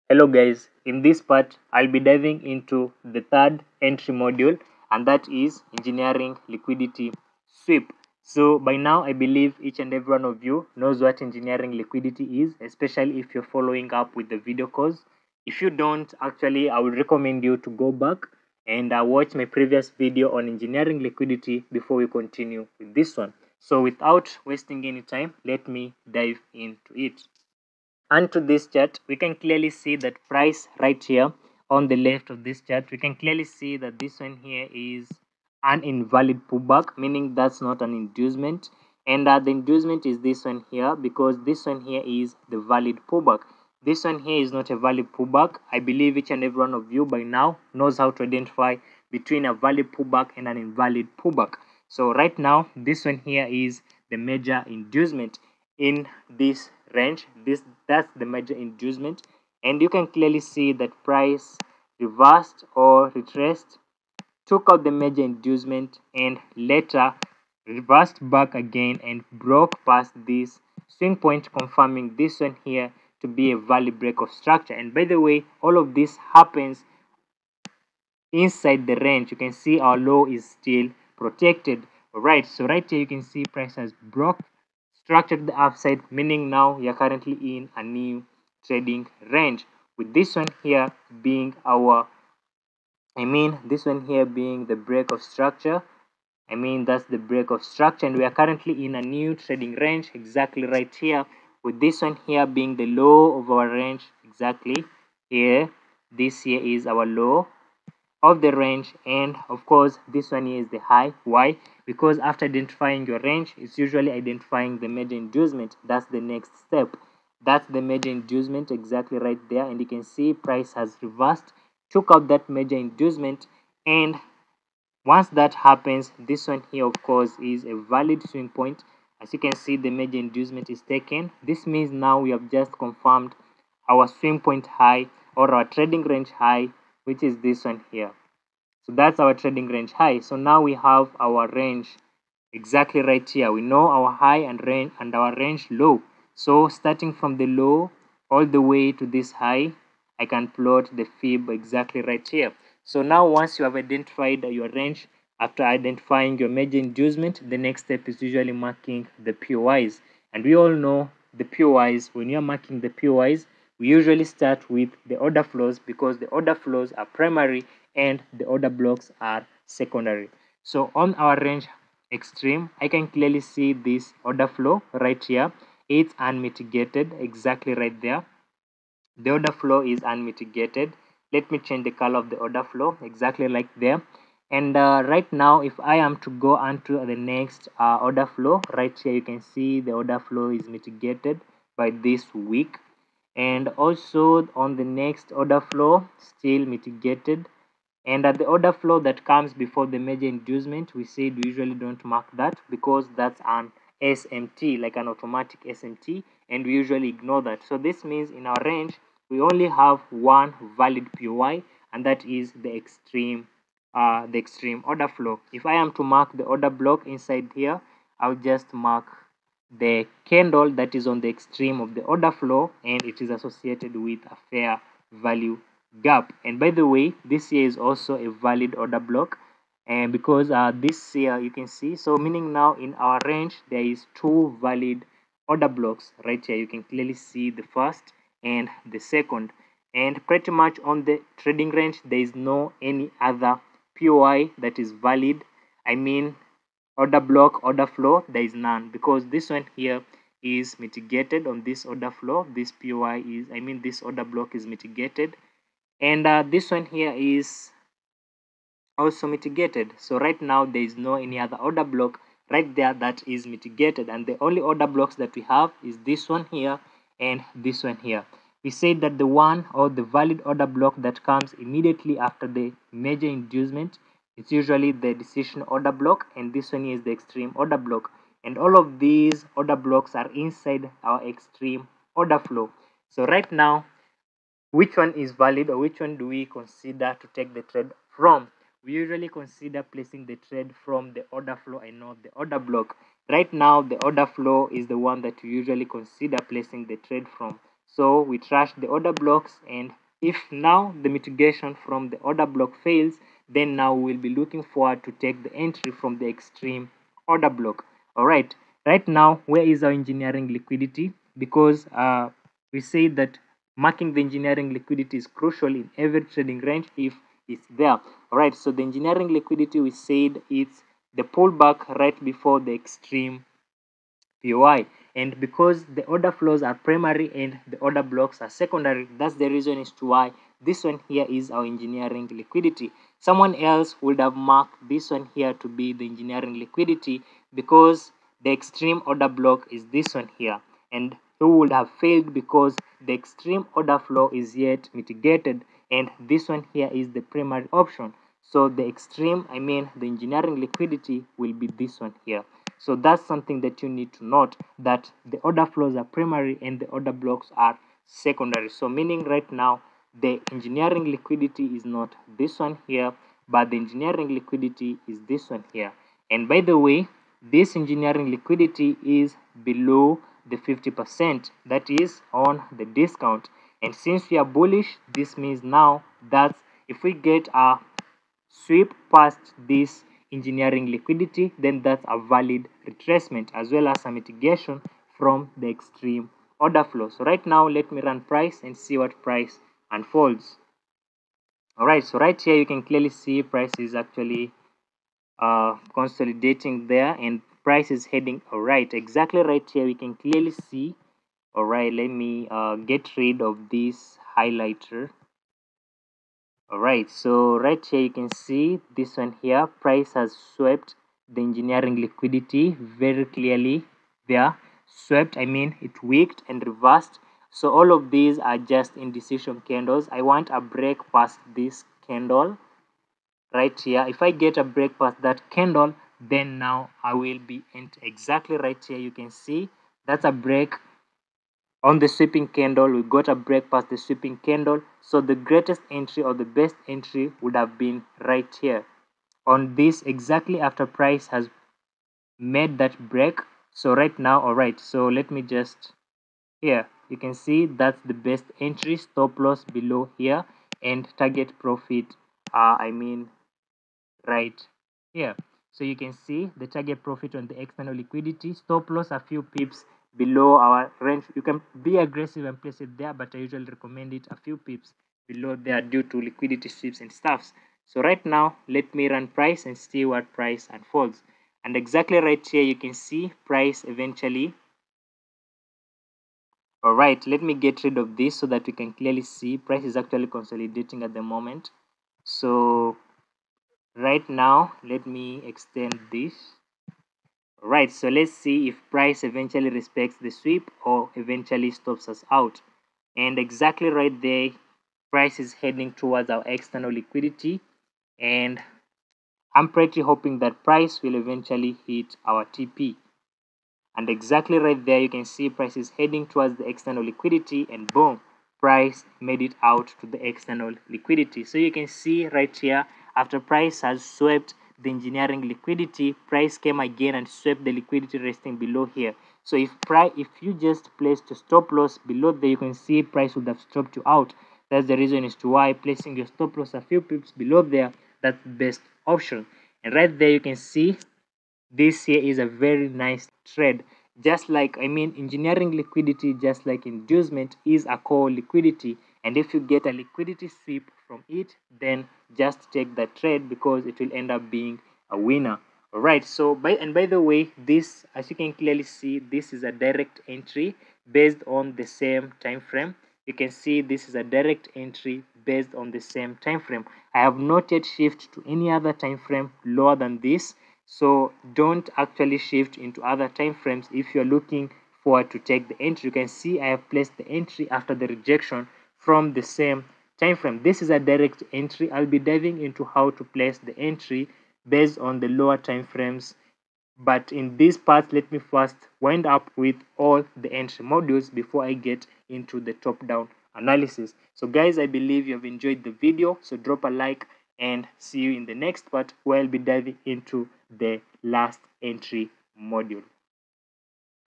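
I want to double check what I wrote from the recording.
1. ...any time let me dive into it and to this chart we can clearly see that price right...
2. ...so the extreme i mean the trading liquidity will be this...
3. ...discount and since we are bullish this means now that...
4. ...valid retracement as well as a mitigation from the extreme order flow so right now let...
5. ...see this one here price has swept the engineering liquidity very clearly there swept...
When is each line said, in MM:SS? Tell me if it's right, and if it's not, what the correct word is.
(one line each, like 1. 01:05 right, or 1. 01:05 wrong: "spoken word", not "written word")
1. 00:24 right
2. 05:48 wrong: "engineering", not "trading"
3. 06:12 right
4. 06:22 right
5. 06:48 right.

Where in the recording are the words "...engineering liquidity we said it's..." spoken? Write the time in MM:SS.
05:18.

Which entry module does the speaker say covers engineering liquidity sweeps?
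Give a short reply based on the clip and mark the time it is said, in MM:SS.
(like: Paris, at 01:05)
third, at 00:03.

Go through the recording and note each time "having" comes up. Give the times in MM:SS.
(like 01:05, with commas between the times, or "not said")
not said.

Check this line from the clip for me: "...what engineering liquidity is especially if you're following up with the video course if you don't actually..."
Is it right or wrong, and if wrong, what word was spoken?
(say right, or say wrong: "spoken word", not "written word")
right.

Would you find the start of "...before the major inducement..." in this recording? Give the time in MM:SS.
03:19.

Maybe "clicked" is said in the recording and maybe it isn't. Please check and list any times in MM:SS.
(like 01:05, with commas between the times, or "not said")
not said.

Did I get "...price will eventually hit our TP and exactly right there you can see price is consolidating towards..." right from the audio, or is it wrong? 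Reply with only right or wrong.
wrong.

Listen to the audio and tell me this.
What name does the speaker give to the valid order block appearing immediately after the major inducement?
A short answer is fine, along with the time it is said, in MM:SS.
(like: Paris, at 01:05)
decision order block, at 04:35.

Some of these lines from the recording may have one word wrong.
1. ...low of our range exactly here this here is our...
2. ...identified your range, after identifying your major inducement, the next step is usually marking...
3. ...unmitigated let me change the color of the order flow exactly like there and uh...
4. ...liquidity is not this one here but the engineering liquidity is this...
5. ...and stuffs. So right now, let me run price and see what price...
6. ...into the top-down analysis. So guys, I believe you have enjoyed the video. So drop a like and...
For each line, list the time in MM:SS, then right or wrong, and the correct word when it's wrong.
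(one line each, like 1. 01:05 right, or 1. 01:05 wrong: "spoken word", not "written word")
1. 01:42 right
2. 02:33 right
3. 03:00 right
4. 06:01 right
5. 07:46 right
6. 09:42 right.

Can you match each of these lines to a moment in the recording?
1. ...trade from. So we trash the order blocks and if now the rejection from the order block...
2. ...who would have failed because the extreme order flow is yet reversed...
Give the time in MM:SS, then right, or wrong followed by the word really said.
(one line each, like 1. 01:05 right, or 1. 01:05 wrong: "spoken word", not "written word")
1. 04:56 wrong: "mitigation", not "rejection"
2. 05:41 wrong: "mitigated", not "reversed".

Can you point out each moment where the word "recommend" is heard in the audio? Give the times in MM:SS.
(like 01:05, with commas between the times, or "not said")
00:17, 07:43.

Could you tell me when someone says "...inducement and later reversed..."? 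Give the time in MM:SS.
01:05.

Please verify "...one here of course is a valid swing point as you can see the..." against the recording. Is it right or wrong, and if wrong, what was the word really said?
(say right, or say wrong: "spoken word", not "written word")
right.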